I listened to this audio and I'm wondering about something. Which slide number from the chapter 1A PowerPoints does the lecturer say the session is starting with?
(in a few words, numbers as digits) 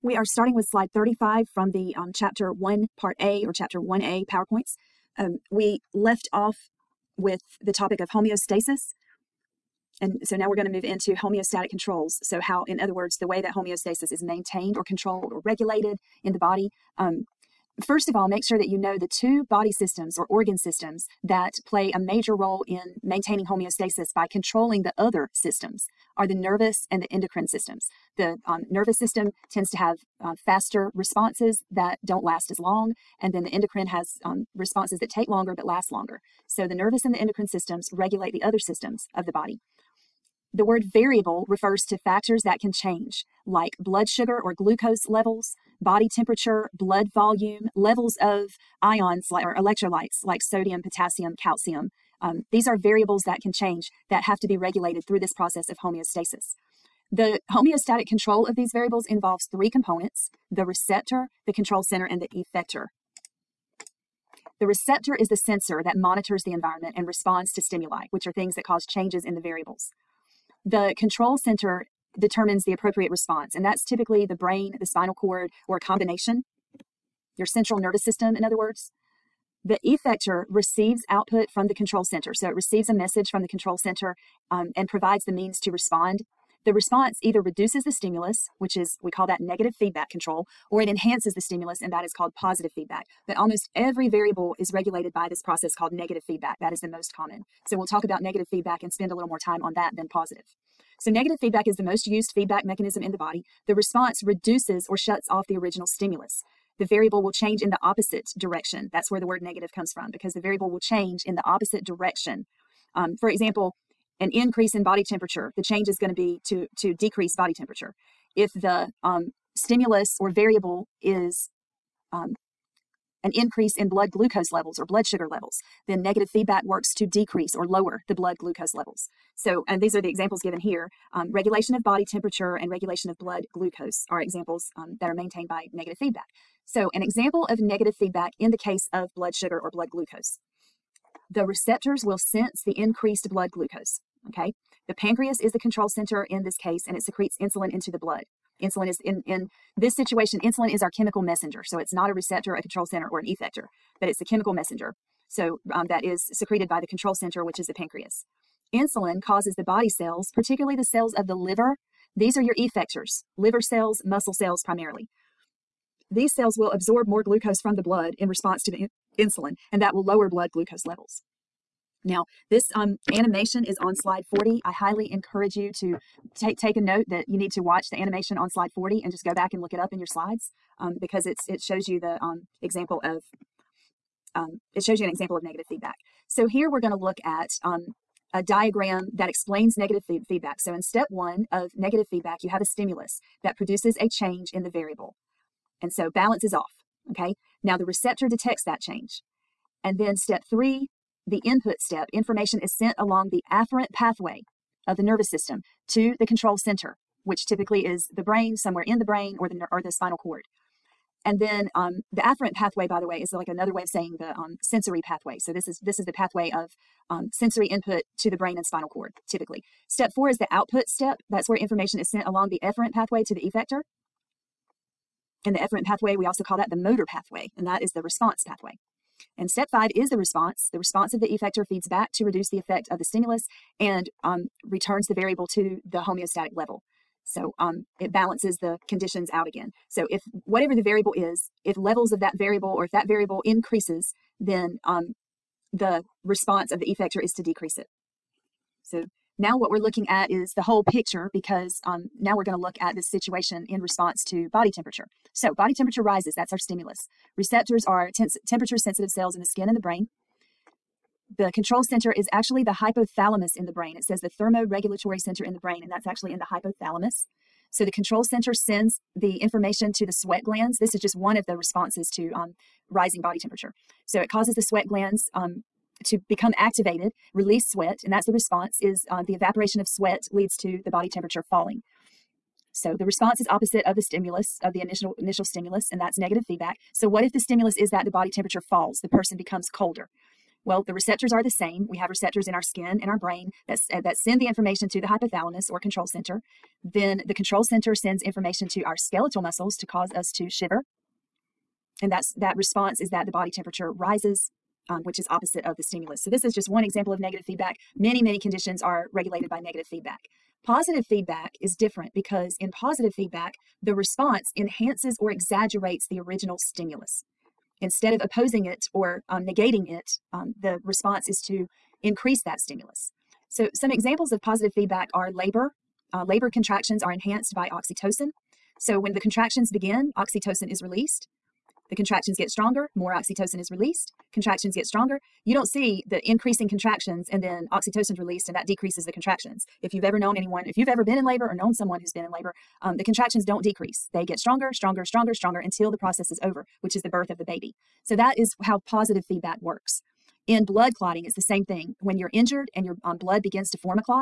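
35.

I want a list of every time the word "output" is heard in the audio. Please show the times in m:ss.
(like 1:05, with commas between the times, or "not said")
1:21, 3:40.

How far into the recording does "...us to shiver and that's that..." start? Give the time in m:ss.
5:00.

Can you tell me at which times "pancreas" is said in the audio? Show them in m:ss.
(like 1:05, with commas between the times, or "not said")
2:24, 2:37.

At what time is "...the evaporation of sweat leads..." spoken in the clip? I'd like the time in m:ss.
4:39.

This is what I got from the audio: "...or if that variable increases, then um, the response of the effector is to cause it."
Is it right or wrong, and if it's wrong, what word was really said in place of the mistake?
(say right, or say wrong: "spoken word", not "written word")
wrong: "decrease", not "cause".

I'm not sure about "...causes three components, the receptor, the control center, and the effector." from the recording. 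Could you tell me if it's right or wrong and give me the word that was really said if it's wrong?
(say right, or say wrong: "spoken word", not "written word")
wrong: "involves", not "causes".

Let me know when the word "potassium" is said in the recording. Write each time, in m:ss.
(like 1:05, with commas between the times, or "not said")
0:50.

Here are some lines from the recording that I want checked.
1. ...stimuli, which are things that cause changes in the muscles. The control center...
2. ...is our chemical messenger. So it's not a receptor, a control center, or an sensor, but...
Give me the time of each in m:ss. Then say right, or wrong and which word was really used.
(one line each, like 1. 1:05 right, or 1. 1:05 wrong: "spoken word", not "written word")
1. 1:07 wrong: "variables", not "muscles"
2. 2:30 wrong: "effector", not "sensor".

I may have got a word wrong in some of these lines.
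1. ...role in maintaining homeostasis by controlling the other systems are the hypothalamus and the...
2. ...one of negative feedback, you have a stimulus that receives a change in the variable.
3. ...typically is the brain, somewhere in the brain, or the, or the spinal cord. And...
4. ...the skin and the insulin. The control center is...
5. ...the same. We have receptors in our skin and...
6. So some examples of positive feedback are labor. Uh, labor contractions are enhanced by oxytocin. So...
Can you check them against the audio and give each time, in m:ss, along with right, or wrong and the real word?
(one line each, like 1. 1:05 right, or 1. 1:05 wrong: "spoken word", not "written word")
1. 0:22 wrong: "nervous", not "hypothalamus"
2. 3:11 wrong: "produces", not "receives"
3. 3:27 right
4. 4:19 wrong: "brain", not "insulin"
5. 4:51 right
6. 5:23 right.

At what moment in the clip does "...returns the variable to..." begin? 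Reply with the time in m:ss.
3:54.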